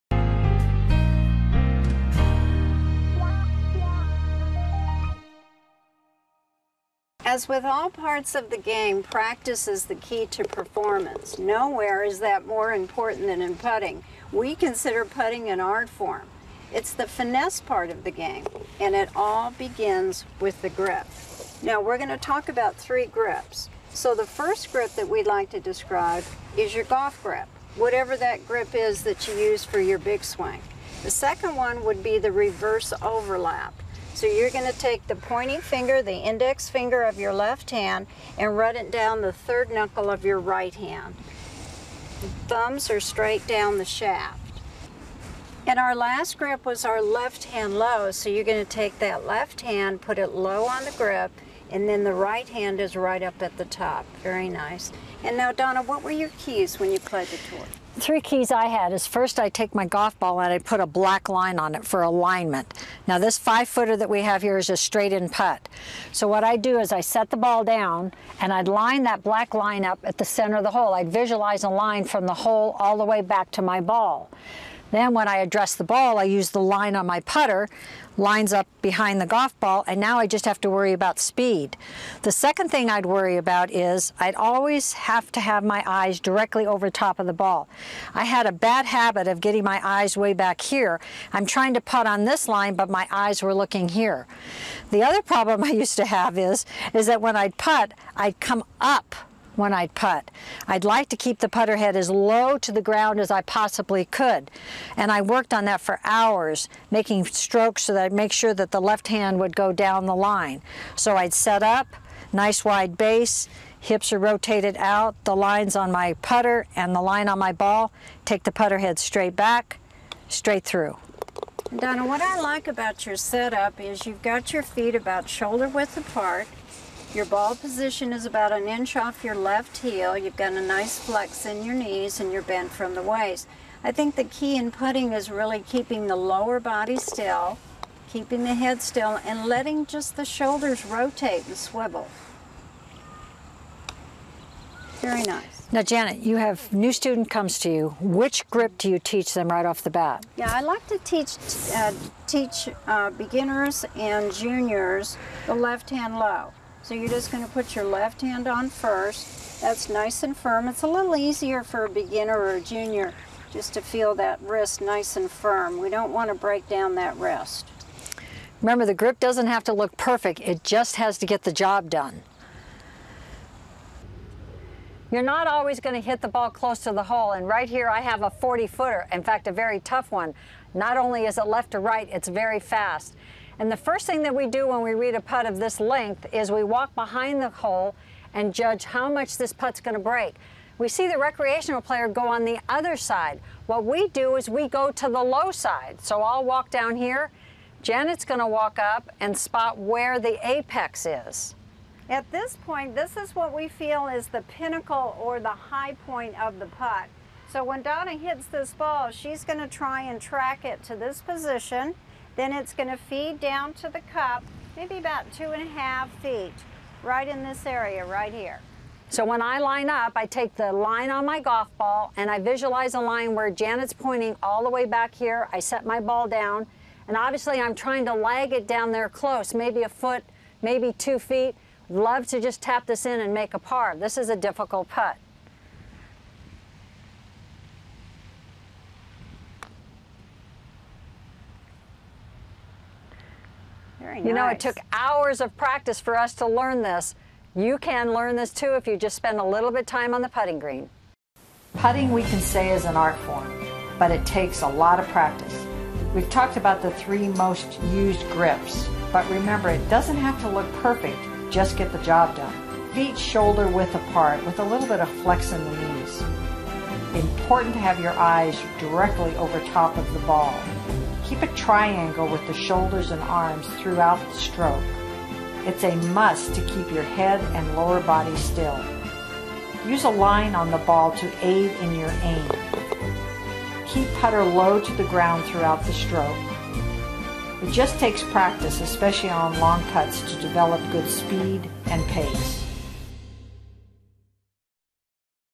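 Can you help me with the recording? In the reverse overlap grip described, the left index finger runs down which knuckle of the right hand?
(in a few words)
third knuckle.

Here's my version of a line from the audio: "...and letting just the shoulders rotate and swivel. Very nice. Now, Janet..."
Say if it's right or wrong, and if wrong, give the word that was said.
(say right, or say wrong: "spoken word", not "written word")
right.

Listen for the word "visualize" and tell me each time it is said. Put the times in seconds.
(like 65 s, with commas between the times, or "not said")
71 s, 222 s.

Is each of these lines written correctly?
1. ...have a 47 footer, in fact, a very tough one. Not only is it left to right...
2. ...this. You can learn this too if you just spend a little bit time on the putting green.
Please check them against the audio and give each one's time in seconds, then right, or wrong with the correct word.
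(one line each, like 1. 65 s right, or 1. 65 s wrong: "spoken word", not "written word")
1. 178 s wrong: "40", not "47"
2. 246 s right.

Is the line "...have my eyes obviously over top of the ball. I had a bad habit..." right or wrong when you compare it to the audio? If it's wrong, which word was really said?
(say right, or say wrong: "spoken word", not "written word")
wrong: "directly", not "obviously".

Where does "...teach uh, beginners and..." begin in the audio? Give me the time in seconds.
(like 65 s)
152 s.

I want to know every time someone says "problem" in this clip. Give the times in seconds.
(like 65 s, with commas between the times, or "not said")
95 s.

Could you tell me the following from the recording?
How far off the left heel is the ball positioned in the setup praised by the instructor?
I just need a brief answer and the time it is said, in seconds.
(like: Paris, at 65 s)
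about an inch, at 128 s.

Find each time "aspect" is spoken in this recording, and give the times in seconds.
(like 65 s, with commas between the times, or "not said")
not said.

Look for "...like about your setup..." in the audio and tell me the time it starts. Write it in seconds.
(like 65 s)
122 s.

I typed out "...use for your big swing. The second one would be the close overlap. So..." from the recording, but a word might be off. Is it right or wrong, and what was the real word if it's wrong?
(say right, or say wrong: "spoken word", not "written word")
wrong: "reverse", not "close".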